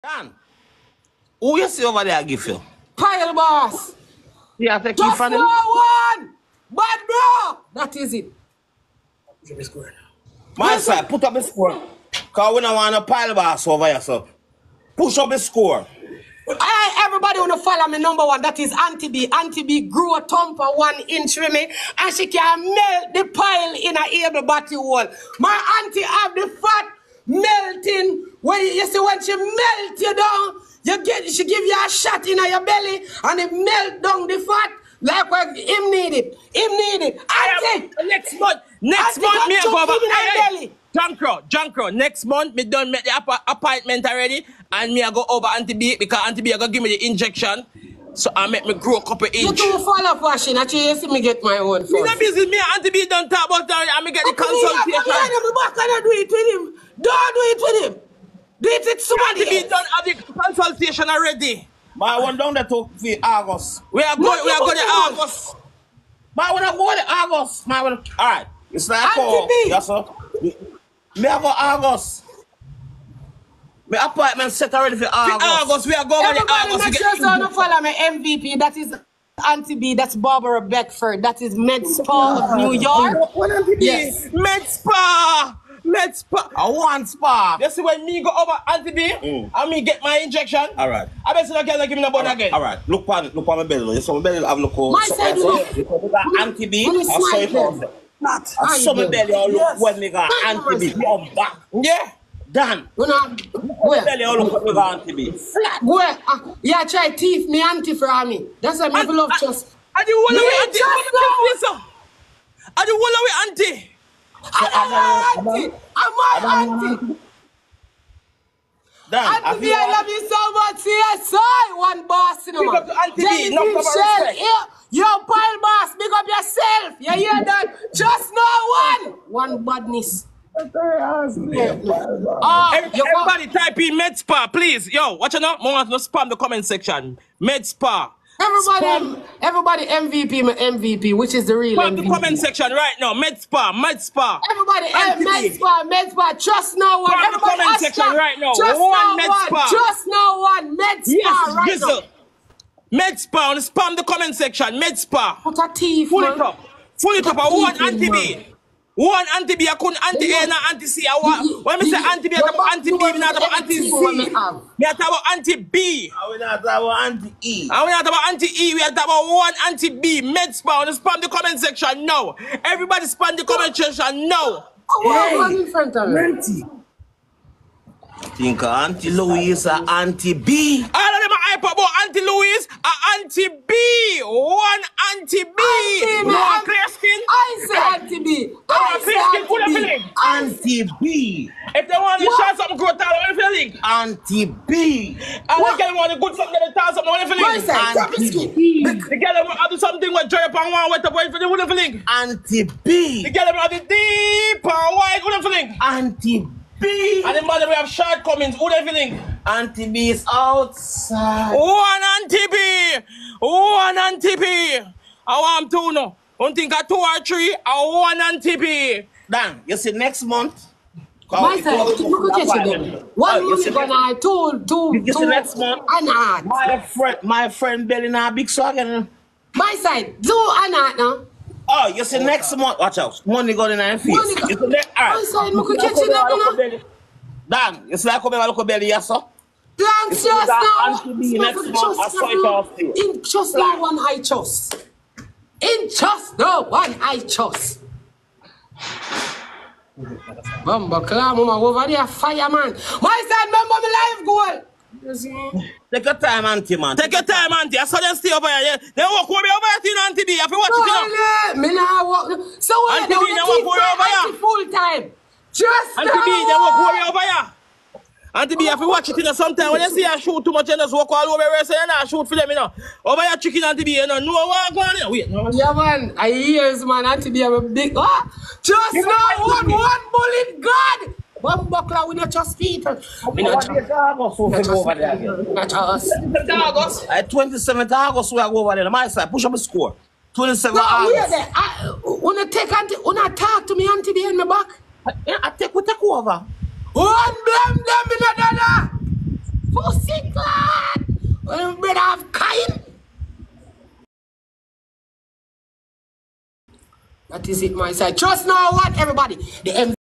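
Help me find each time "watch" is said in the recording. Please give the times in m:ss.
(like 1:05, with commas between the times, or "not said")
2:15, 3:52, 4:28.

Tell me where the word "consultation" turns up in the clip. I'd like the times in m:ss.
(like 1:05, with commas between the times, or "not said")
0:54, 1:00.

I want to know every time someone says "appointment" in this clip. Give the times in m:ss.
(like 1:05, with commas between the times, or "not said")
0:43, 1:14.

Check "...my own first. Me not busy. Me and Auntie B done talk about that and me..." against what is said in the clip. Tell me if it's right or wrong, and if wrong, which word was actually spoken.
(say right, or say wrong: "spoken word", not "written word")
right.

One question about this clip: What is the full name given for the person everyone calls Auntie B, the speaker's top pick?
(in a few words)
Barbara Beckford.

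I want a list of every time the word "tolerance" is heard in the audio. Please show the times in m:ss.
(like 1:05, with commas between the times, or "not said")
not said.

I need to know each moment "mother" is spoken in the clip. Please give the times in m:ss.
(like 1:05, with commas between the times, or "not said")
3:27.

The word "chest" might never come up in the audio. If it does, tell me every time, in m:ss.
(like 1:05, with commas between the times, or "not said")
4:04, 4:42.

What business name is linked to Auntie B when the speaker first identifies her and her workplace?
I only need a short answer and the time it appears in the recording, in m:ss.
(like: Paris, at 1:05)
Med Spa of New York, at 1:21.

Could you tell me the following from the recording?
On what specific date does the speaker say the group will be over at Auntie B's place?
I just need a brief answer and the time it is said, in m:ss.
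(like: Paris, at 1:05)
27th August, at 4:47.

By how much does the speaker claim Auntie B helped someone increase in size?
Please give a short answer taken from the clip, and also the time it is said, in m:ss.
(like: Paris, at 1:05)
one inch, at 0:20.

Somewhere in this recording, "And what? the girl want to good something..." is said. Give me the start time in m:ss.
3:15.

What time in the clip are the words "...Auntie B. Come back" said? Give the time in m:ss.
1:40.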